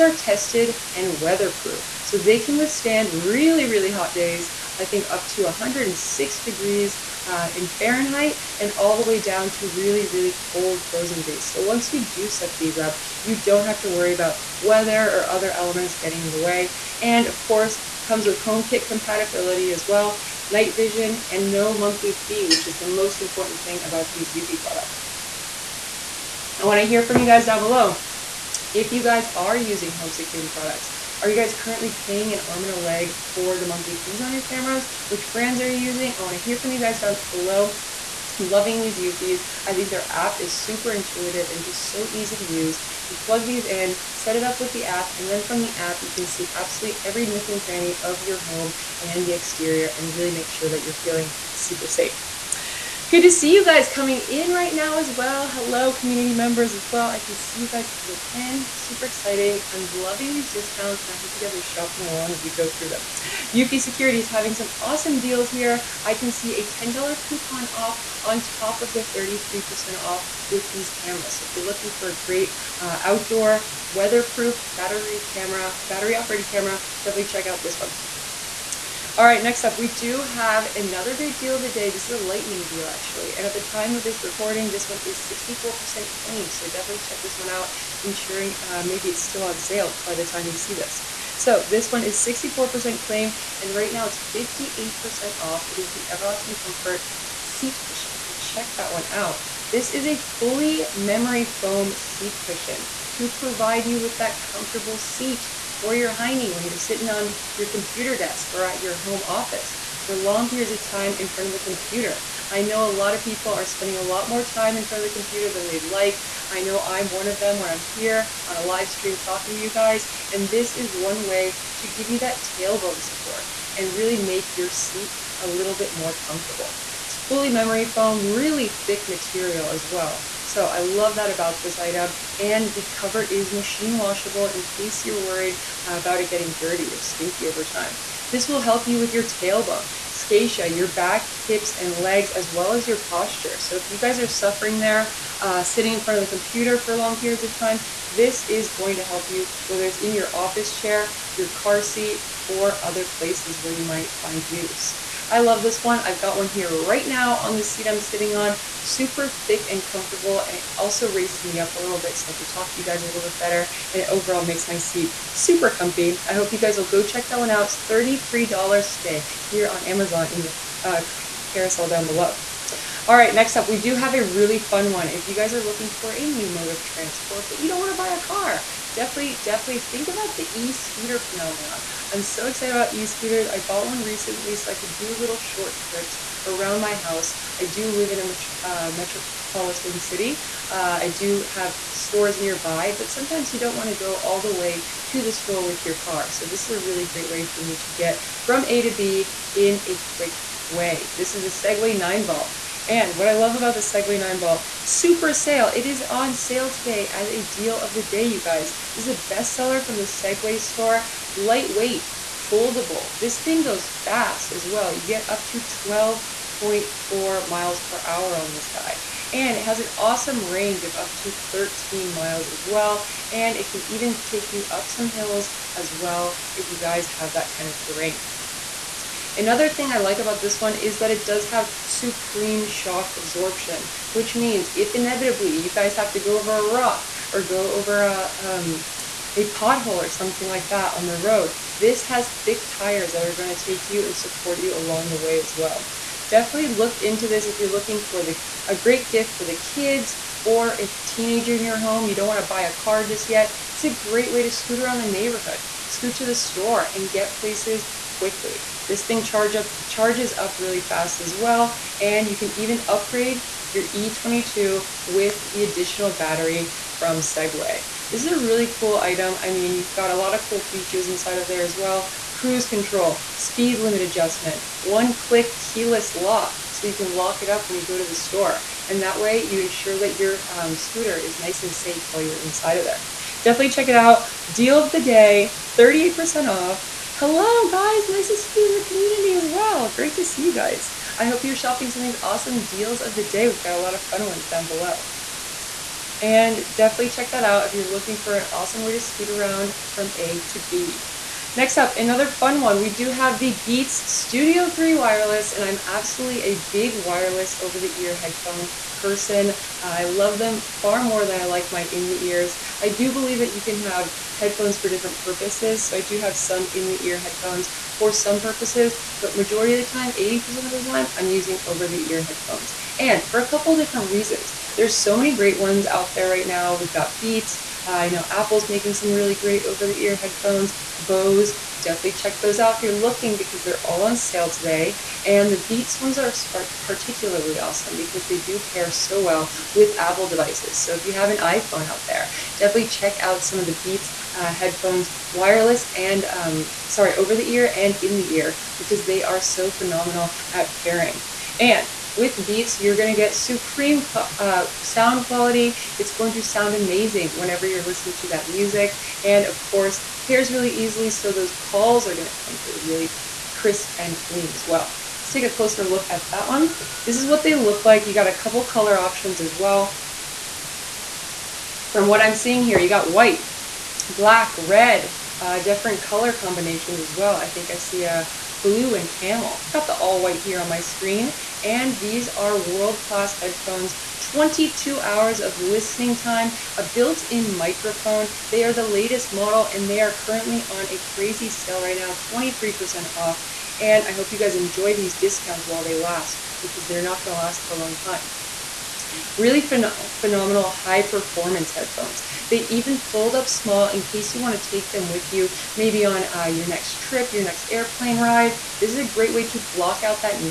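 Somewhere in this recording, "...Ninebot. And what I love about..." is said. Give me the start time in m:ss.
3:21.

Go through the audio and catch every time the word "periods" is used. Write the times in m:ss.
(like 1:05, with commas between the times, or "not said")
1:50, 2:27.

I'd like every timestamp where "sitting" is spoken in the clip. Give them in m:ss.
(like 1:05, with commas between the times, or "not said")
1:46, 2:25, 2:38.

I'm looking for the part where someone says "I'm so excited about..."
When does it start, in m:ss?
3:02.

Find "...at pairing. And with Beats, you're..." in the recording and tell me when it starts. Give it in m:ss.
5:50.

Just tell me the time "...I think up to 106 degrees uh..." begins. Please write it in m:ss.
0:04.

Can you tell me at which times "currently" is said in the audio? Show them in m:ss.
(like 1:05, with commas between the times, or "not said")
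0:31, 6:30.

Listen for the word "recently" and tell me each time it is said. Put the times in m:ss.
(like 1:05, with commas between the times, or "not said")
3:04.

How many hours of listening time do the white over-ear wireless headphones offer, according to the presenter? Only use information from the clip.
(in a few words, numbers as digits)
22 hours.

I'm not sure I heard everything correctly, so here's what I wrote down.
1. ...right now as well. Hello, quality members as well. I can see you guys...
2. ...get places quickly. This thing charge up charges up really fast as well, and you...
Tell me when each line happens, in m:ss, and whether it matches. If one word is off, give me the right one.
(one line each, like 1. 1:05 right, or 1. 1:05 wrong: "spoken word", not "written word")
1. 0:54 wrong: "community", not "quality"
2. 4:17 right.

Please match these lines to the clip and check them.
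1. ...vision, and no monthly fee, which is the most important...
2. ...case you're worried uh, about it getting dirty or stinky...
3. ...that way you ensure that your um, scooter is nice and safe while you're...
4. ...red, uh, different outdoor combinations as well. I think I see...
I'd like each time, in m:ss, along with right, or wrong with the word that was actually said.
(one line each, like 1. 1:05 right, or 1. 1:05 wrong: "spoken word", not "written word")
1. 0:20 right
2. 2:14 right
3. 4:39 right
4. 6:14 wrong: "color", not "outdoor".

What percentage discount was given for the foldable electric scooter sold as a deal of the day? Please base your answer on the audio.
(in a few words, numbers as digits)
38%.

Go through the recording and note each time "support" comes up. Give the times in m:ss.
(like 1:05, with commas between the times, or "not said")
2:03, 4:04.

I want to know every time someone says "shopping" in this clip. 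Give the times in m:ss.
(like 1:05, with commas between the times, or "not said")
1:01, 4:51.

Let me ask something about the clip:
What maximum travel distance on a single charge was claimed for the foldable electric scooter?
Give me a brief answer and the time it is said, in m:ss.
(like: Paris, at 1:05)
13 miles, at 3:41.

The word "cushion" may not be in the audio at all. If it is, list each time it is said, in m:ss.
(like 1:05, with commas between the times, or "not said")
1:37, 1:42.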